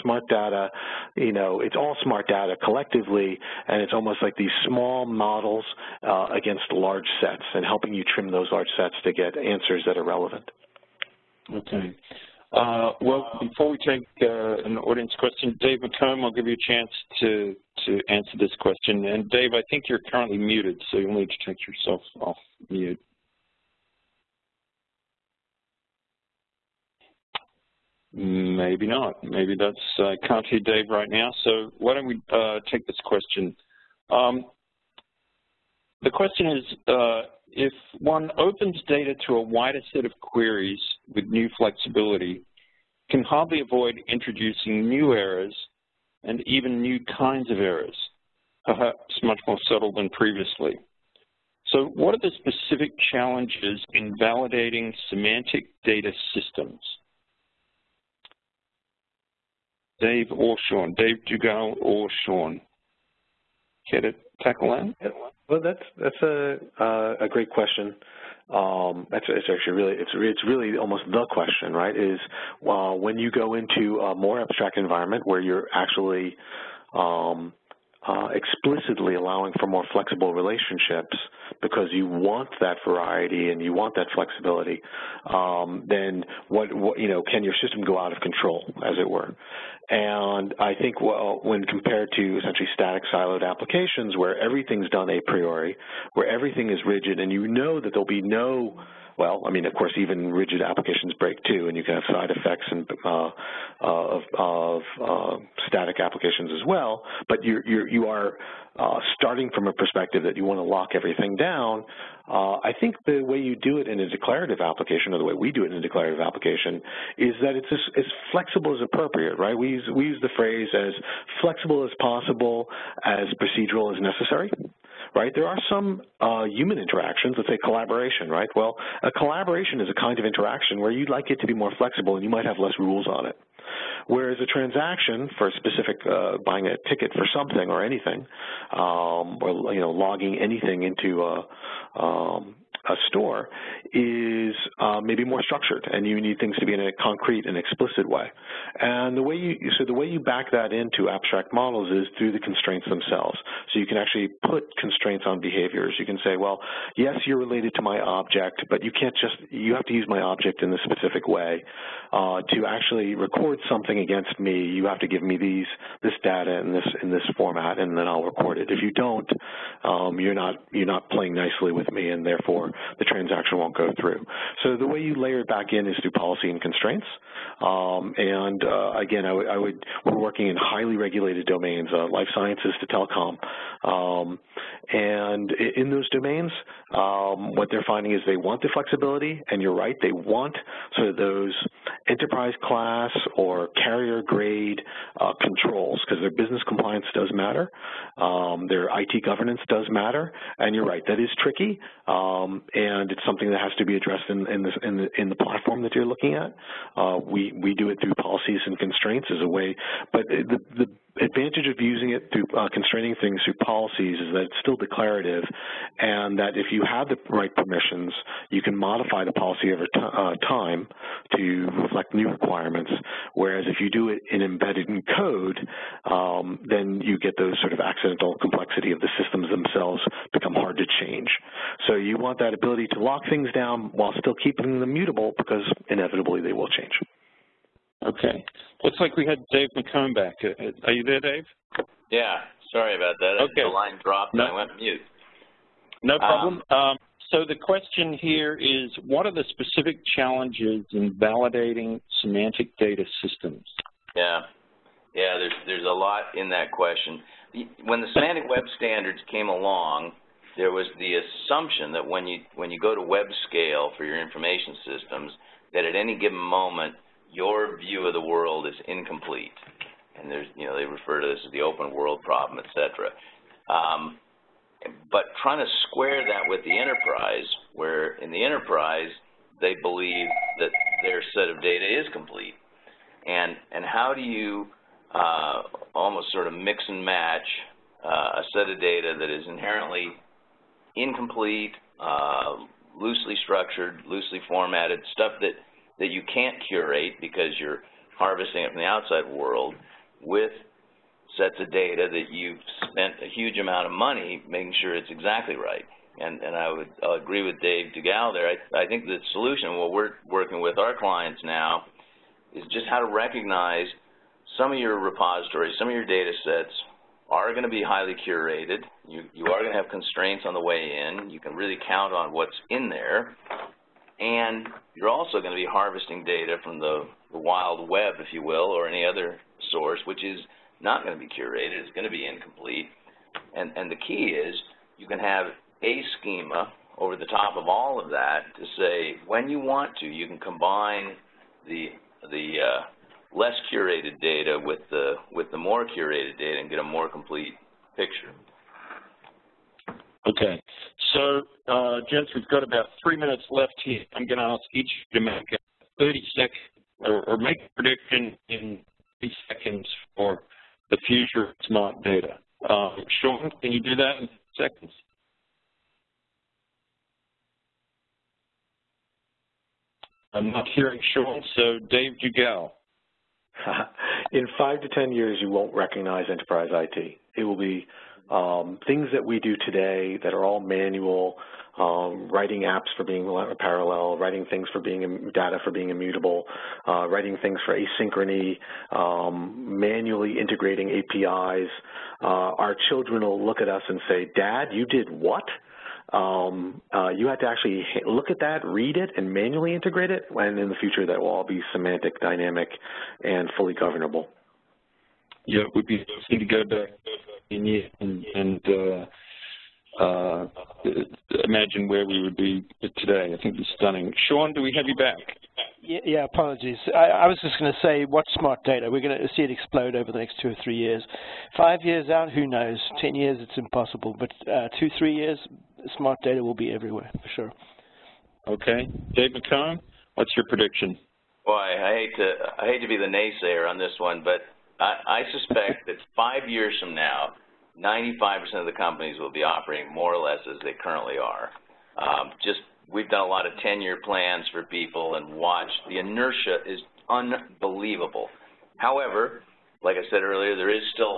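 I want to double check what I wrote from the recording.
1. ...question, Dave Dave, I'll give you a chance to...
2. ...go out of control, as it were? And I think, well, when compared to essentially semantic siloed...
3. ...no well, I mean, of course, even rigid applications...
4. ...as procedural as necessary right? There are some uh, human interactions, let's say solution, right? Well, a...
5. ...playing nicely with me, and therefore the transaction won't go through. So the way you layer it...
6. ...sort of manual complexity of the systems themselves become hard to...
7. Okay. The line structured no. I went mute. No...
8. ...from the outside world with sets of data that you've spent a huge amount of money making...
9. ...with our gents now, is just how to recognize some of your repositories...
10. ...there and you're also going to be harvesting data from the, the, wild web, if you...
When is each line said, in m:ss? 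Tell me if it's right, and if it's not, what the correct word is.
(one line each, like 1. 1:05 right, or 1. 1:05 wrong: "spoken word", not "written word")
1. 0:15 wrong: "McComb", not "Dave"
2. 1:27 wrong: "static", not "semantic"
3. 1:38 right
4. 2:03 wrong: "collaboration", not "solution"
5. 2:51 right
6. 3:47 wrong: "accidental", not "manual"
7. 4:03 wrong: "dropped", not "structured"
8. 4:58 right
9. 5:10 wrong: "clients", not "gents"
10. 5:22 right.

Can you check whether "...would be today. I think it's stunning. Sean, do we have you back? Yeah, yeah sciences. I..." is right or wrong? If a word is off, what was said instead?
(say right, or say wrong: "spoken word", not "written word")
wrong: "apologies", not "sciences".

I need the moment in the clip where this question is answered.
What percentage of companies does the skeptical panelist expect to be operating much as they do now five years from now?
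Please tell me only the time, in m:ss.
7:17.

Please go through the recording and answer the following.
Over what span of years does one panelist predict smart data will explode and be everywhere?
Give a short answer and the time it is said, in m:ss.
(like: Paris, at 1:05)
Two or three years, at 7:00.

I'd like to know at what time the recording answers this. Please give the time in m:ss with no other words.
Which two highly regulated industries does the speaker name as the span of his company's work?
3:02.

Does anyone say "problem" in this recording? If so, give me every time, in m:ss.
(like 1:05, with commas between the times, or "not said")
4:06, 4:32.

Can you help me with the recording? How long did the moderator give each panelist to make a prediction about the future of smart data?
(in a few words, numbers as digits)
30 seconds.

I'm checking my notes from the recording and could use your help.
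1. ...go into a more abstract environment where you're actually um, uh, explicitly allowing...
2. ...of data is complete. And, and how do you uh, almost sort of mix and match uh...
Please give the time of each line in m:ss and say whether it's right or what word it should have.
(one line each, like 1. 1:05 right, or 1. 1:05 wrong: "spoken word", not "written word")
1. 1:13 right
2. 4:41 right.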